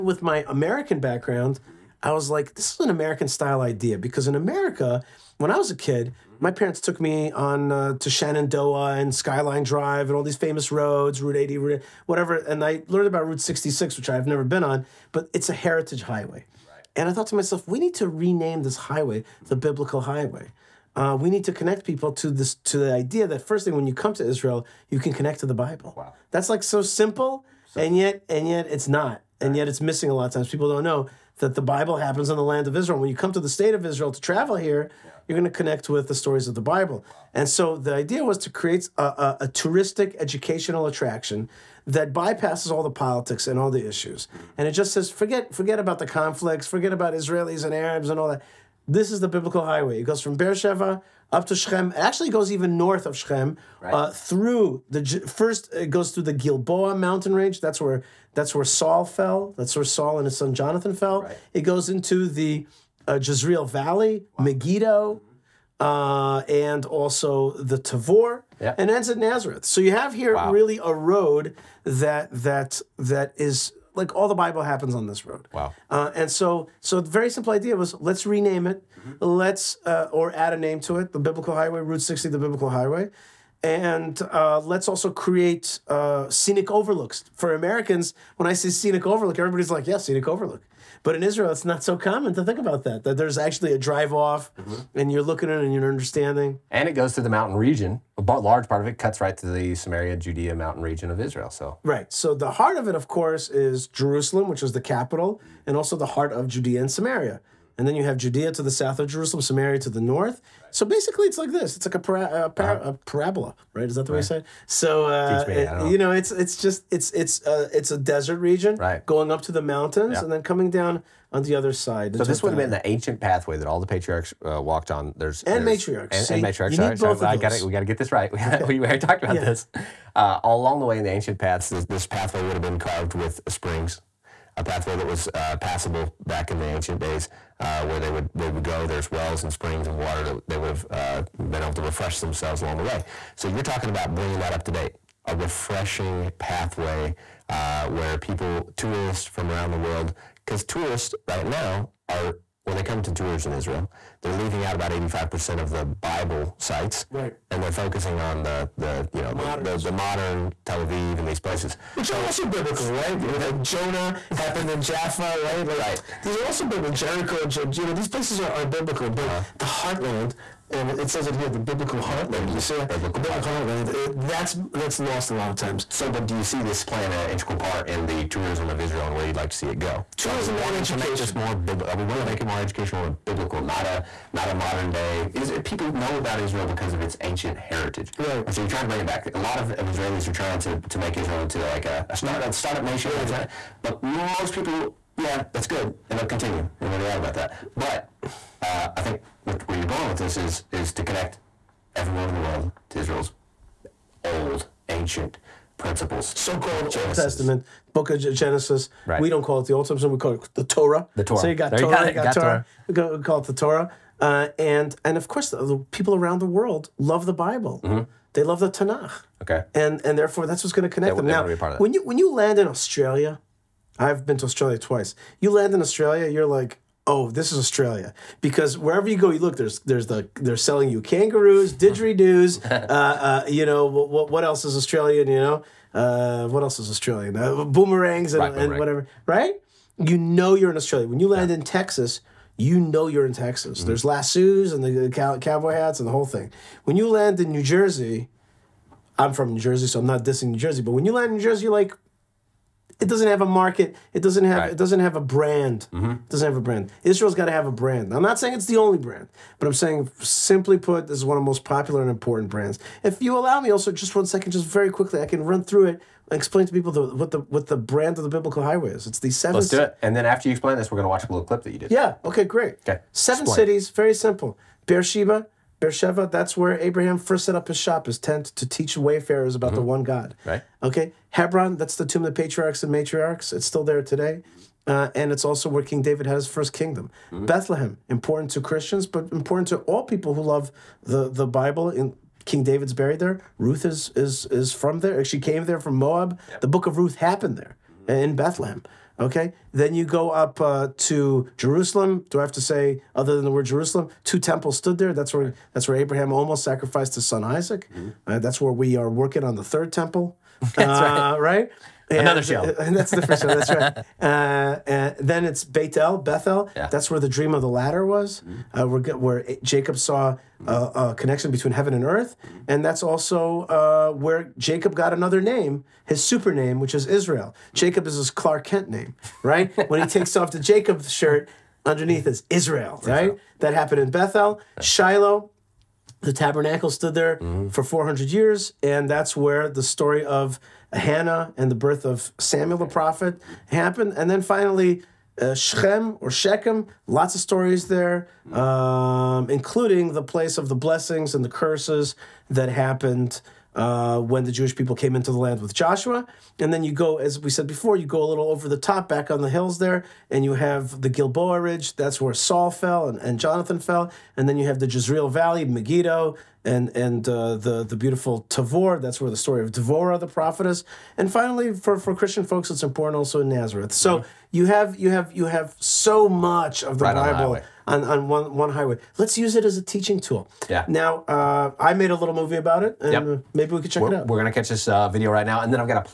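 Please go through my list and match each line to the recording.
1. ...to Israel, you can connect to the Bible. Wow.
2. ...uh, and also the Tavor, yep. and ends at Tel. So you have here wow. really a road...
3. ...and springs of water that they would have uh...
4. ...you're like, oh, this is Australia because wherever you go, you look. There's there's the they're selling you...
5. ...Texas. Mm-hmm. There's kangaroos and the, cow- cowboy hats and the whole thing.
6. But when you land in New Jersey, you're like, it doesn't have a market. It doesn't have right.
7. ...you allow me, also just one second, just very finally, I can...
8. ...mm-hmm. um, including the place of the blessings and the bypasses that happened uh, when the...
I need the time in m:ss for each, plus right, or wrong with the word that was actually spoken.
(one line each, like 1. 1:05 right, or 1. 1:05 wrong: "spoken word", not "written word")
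1. 0:24 right
2. 1:05 wrong: "Nazareth", not "Tel"
3. 2:19 right
4. 3:46 right
5. 4:03 wrong: "lassos", not "kangaroos"
6. 4:10 right
7. 4:23 wrong: "quickly", not "finally"
8. 5:48 wrong: "curses", not "bypasses".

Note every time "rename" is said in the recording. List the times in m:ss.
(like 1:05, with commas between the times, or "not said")
0:18, 1:18.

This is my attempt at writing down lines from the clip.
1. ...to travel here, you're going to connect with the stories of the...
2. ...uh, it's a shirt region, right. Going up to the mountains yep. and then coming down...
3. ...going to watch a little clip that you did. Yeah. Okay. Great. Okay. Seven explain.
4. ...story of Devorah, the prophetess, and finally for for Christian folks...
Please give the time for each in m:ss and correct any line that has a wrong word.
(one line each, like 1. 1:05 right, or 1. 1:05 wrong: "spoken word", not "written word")
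1. 0:34 right
2. 1:57 wrong: "desert", not "shirt"
3. 4:30 right
4. 6:09 right.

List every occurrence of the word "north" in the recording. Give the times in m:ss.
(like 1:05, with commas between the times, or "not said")
0:52, 1:49.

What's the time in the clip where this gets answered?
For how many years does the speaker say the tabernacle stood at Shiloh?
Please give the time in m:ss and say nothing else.
5:37.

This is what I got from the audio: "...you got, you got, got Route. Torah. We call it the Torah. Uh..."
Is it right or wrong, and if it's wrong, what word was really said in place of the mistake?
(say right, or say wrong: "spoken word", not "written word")
wrong: "Torah", not "Route".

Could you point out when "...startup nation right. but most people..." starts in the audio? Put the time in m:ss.
3:12.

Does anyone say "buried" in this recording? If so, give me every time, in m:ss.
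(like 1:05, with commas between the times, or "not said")
4:52.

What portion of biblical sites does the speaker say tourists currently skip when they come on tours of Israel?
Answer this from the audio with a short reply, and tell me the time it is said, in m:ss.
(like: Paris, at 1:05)
85%, at 2:34.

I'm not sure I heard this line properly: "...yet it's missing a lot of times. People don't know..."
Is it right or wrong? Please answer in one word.
right.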